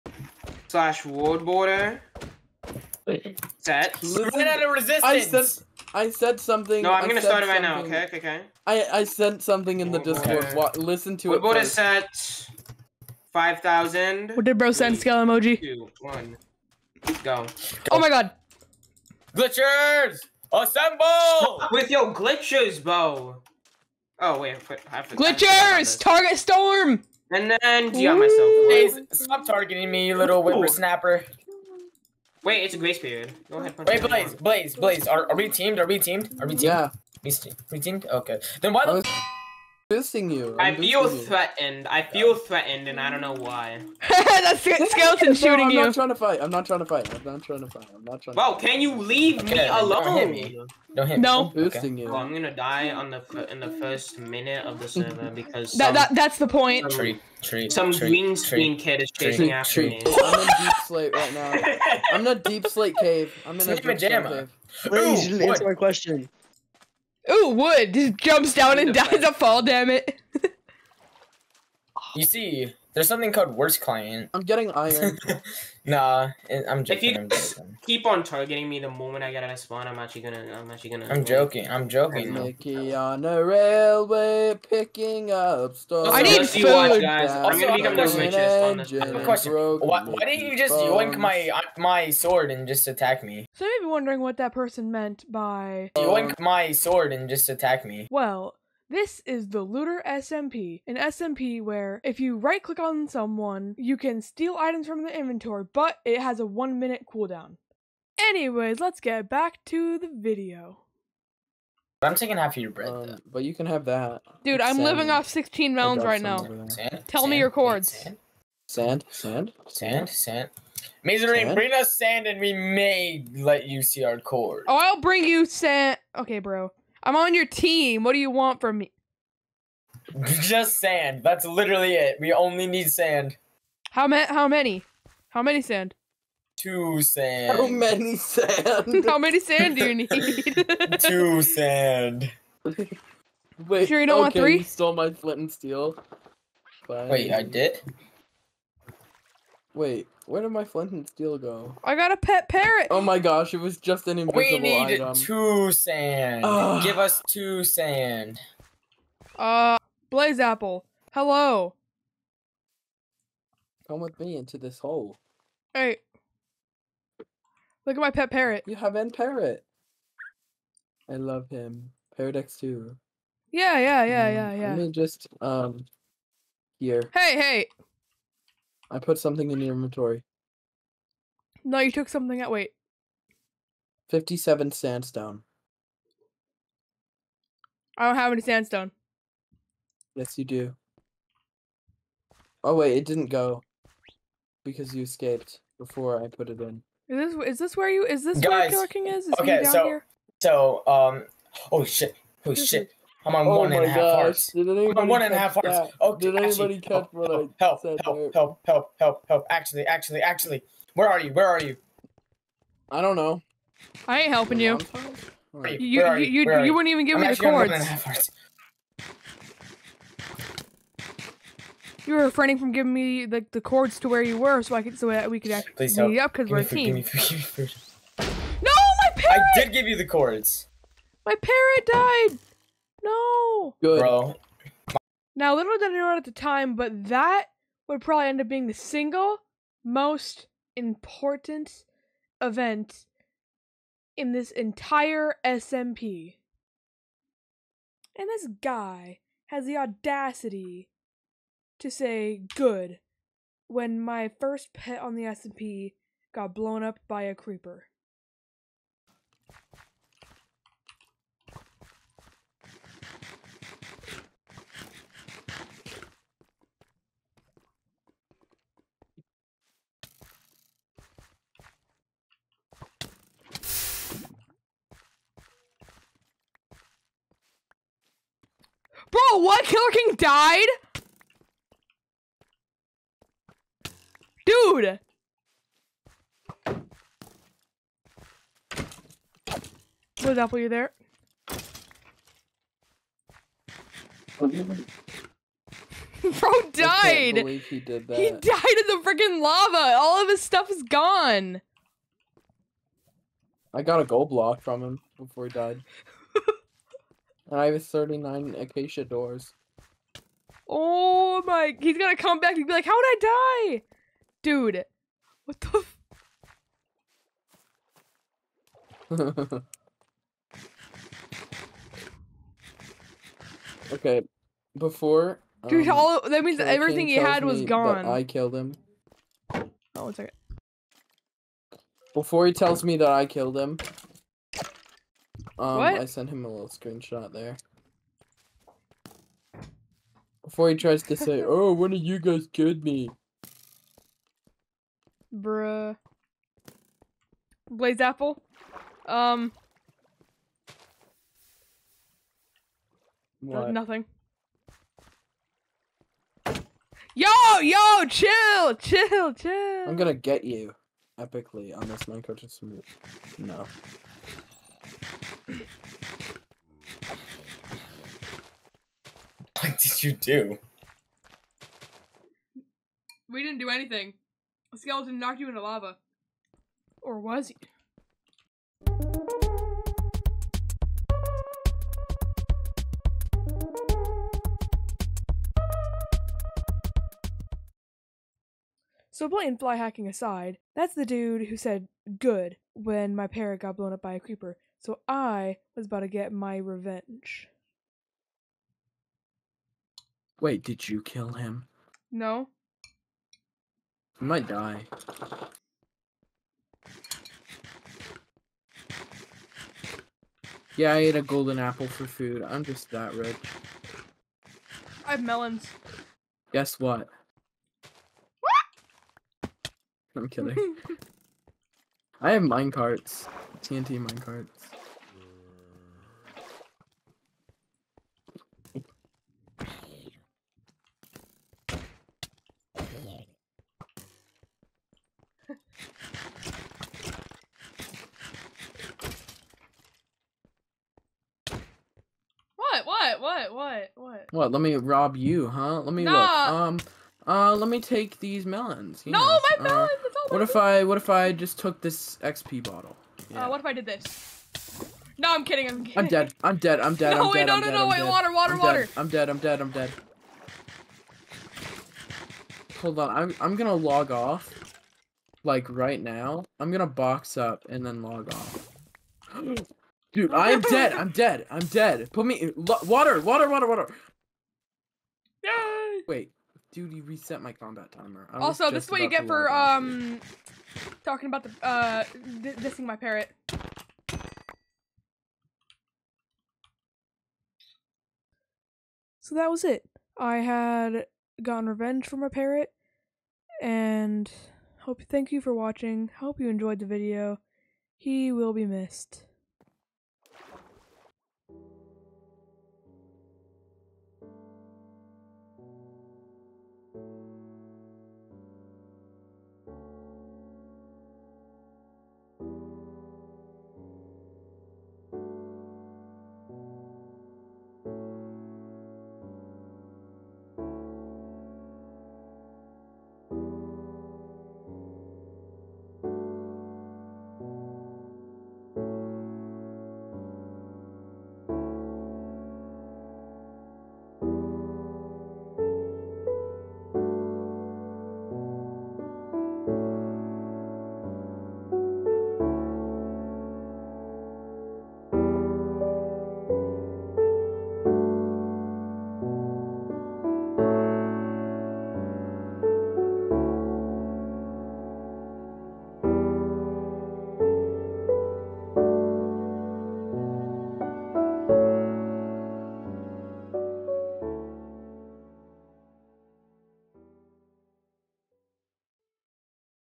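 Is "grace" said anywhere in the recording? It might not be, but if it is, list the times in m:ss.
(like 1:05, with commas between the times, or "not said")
0:32.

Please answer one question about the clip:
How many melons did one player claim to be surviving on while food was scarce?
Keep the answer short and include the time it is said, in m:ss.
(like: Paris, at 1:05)
16, at 1:55.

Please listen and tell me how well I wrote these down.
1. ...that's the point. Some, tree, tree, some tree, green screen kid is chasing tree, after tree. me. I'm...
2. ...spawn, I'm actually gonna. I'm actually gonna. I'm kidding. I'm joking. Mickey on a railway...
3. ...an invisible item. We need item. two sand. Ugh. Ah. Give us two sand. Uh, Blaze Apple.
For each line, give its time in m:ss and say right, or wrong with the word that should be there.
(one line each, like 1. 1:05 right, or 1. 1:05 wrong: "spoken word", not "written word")
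1. 0:56 right
2. 1:19 wrong: "joking", not "kidding"
3. 2:34 right.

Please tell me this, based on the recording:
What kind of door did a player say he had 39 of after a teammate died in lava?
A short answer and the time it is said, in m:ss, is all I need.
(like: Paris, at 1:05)
Acacia, at 5:08.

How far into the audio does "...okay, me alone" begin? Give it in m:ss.
0:49.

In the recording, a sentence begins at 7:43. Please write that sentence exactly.
I'm I'm gonna log off, like right now.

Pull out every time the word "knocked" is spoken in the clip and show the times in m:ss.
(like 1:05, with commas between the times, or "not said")
6:15.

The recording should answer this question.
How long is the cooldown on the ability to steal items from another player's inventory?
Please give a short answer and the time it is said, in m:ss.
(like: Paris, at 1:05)
One minute, at 1:46.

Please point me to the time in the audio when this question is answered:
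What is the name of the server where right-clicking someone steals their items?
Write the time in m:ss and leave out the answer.
1:39.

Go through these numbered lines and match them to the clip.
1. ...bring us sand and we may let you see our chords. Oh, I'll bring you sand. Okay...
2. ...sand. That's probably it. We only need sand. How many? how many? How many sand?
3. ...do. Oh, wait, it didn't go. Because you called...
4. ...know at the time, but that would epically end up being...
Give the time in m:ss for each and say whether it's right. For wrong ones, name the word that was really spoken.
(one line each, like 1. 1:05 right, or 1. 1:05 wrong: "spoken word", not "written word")
1. 2:01 right
2. 2:10 wrong: "literally", not "probably"
3. 3:10 wrong: "escaped", not "called"
4. 3:55 wrong: "probably", not "epically".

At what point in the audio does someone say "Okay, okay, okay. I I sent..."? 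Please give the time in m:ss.
0:07.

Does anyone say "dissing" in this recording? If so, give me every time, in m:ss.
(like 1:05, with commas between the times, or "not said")
0:39, 8:02.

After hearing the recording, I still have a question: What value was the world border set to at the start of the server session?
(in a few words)
5000.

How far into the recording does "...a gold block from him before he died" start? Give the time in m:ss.
5:04.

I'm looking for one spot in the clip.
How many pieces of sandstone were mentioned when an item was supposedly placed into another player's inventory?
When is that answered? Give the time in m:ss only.
3:04.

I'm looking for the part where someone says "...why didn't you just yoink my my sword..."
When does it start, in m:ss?
1:30.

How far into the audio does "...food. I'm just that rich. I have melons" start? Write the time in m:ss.
6:52.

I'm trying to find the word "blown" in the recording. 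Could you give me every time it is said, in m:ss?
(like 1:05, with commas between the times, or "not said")
4:16, 6:33.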